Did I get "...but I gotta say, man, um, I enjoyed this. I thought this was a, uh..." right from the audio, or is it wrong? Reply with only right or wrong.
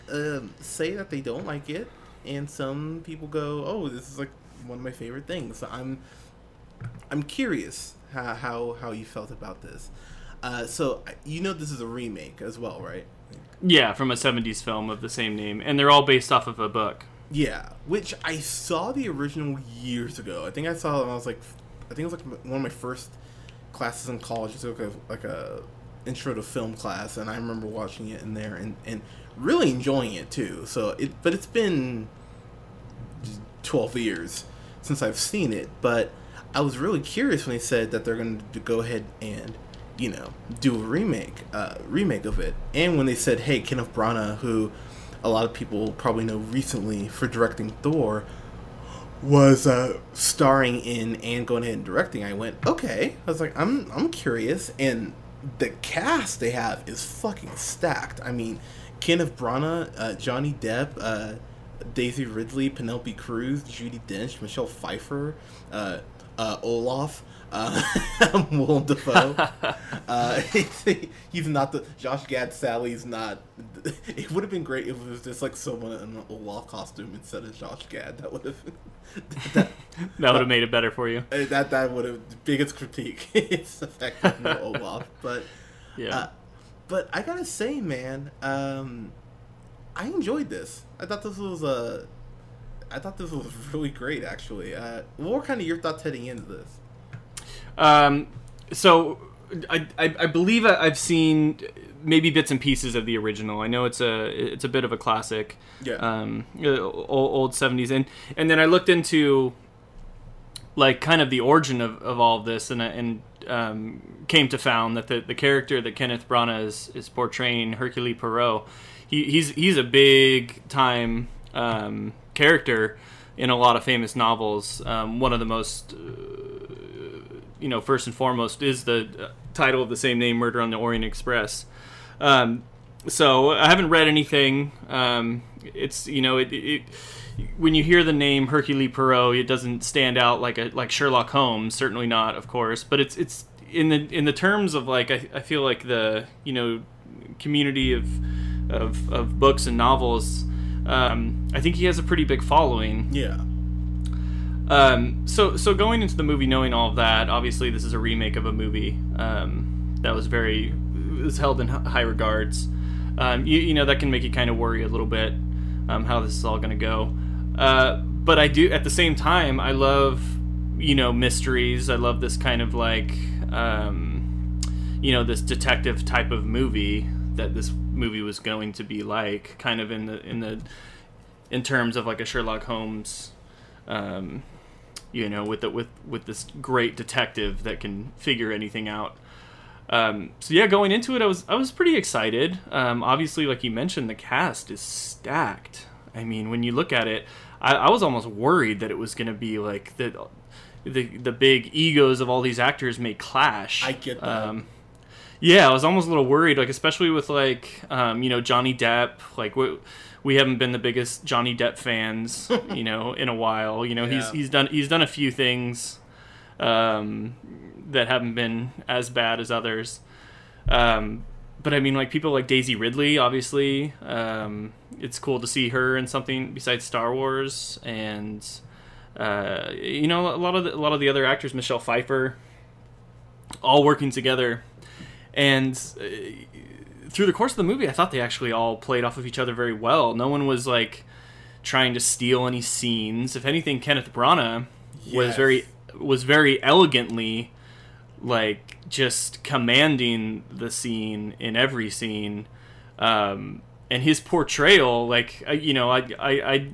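right.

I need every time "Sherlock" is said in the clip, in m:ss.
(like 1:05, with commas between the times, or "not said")
2:20, 3:02.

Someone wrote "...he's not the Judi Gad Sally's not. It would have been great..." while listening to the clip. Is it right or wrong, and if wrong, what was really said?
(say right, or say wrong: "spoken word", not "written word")
wrong: "Josh", not "Judi".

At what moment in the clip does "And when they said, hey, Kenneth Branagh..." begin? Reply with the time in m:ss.
0:42.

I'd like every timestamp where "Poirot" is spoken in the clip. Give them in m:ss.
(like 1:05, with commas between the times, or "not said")
1:58, 2:18.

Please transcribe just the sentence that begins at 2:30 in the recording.
Um, I think he has a pretty big following.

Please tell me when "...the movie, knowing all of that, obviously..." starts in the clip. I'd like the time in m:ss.
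2:36.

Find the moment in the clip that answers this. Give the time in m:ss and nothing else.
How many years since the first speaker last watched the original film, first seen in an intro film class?
0:33.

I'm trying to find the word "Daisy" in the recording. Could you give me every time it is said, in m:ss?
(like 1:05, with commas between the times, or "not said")
1:01, 3:42.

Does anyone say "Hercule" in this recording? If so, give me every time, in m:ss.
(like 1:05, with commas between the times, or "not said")
1:57, 2:18.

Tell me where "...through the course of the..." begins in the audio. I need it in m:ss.
3:57.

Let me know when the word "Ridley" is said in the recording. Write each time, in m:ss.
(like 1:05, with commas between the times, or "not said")
1:02, 3:42.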